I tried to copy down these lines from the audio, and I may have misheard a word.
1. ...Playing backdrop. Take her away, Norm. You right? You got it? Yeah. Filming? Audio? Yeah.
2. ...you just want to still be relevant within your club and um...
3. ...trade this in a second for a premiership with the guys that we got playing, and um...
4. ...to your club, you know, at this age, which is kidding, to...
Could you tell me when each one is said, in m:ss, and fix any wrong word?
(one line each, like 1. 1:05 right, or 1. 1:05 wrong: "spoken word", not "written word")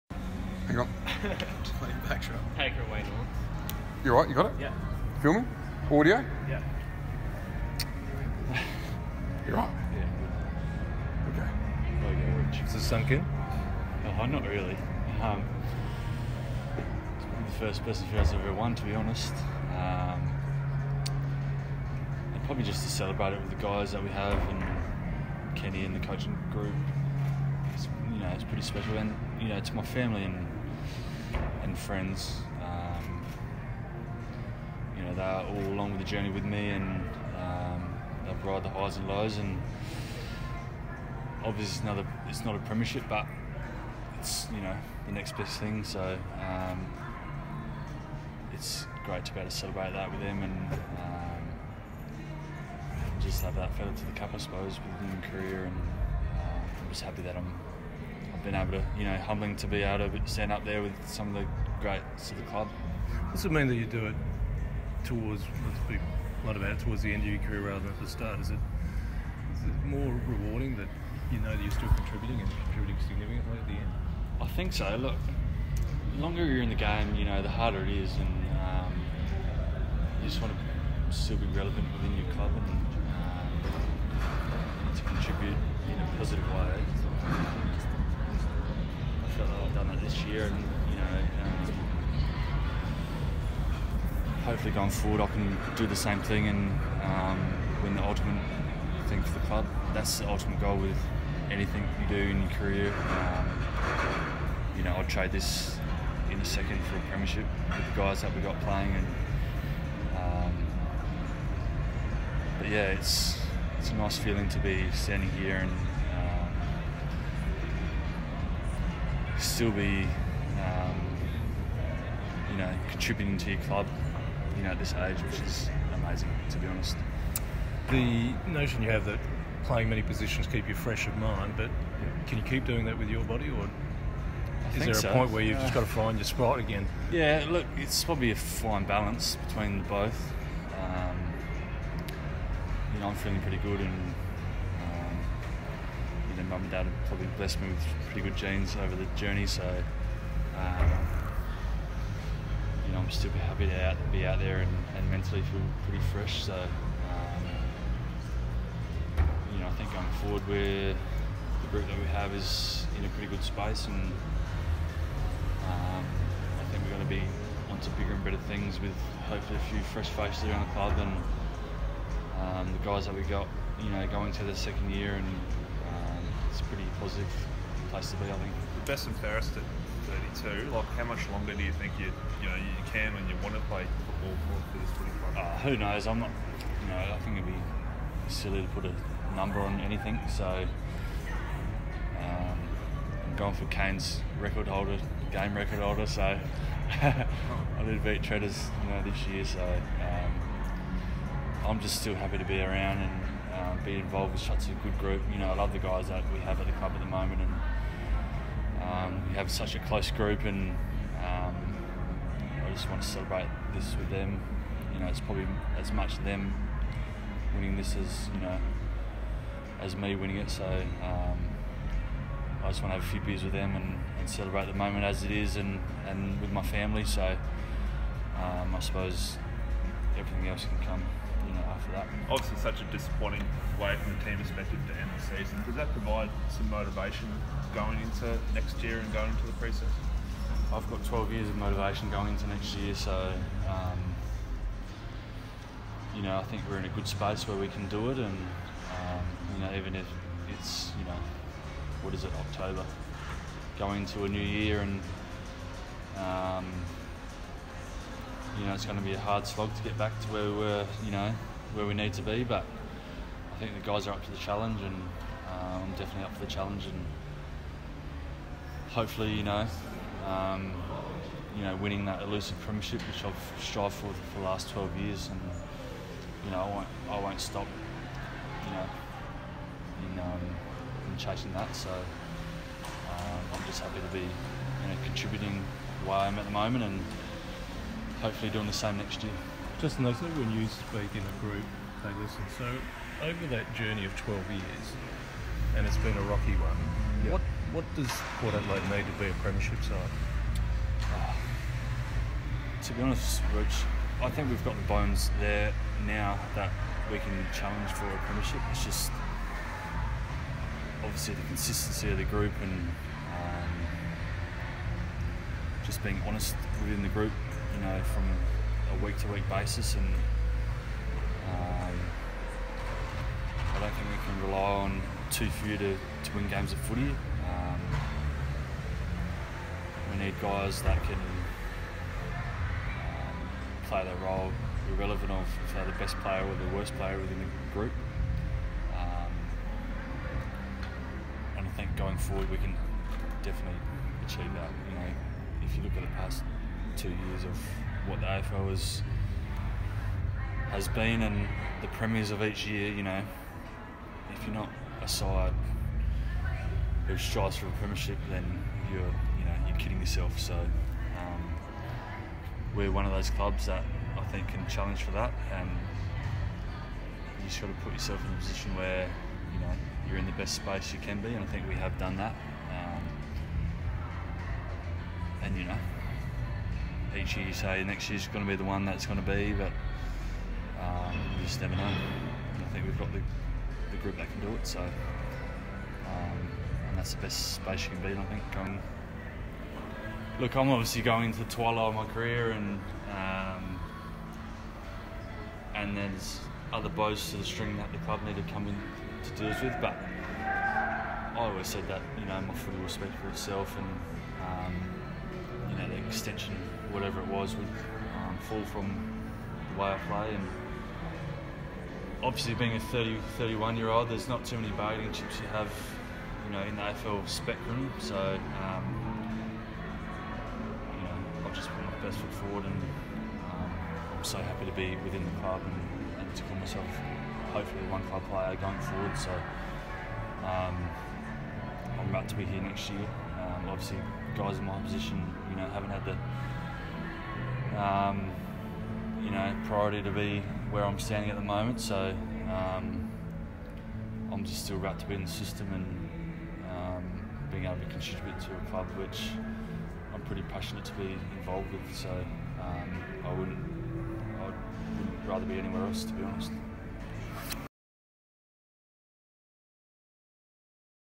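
1. 0:01 right
2. 1:20 right
3. 1:45 right
4. 2:03 wrong: "amazing", not "kidding".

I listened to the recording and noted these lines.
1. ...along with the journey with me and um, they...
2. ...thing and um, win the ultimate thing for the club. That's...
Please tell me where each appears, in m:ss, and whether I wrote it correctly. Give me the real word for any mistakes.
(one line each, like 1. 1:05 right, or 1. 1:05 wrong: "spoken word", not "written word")
1. 0:35 right
2. 1:36 right.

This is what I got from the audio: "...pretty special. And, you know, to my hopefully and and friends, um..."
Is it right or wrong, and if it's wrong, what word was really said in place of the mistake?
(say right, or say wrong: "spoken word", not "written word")
wrong: "family", not "hopefully".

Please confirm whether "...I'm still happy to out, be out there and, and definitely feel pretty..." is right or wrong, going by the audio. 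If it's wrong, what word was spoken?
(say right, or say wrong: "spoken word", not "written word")
wrong: "mentally", not "definitely".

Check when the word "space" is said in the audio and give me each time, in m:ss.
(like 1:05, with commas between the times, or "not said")
2:43, 4:07, 6:10, 6:27.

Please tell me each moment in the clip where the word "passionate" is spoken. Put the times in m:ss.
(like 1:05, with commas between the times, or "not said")
7:30.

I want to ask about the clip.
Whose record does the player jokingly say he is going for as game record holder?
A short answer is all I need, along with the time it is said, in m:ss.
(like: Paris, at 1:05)
Kane, at 3:13.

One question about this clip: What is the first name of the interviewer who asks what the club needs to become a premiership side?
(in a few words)
Rich.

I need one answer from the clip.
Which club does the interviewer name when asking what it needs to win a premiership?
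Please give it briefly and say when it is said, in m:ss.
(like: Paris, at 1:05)
Port Adelaide, at 4:58.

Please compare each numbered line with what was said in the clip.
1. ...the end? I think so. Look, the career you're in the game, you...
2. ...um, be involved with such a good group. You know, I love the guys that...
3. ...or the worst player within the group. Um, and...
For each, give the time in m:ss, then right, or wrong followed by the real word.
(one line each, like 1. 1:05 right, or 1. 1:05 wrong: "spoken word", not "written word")
1. 1:13 wrong: "longer", not "career"
2. 3:23 right
3. 5:36 right.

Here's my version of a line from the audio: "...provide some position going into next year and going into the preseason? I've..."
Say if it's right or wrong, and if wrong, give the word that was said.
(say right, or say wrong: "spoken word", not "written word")
wrong: "motivation", not "position".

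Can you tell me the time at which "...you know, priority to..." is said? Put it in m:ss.
7:19.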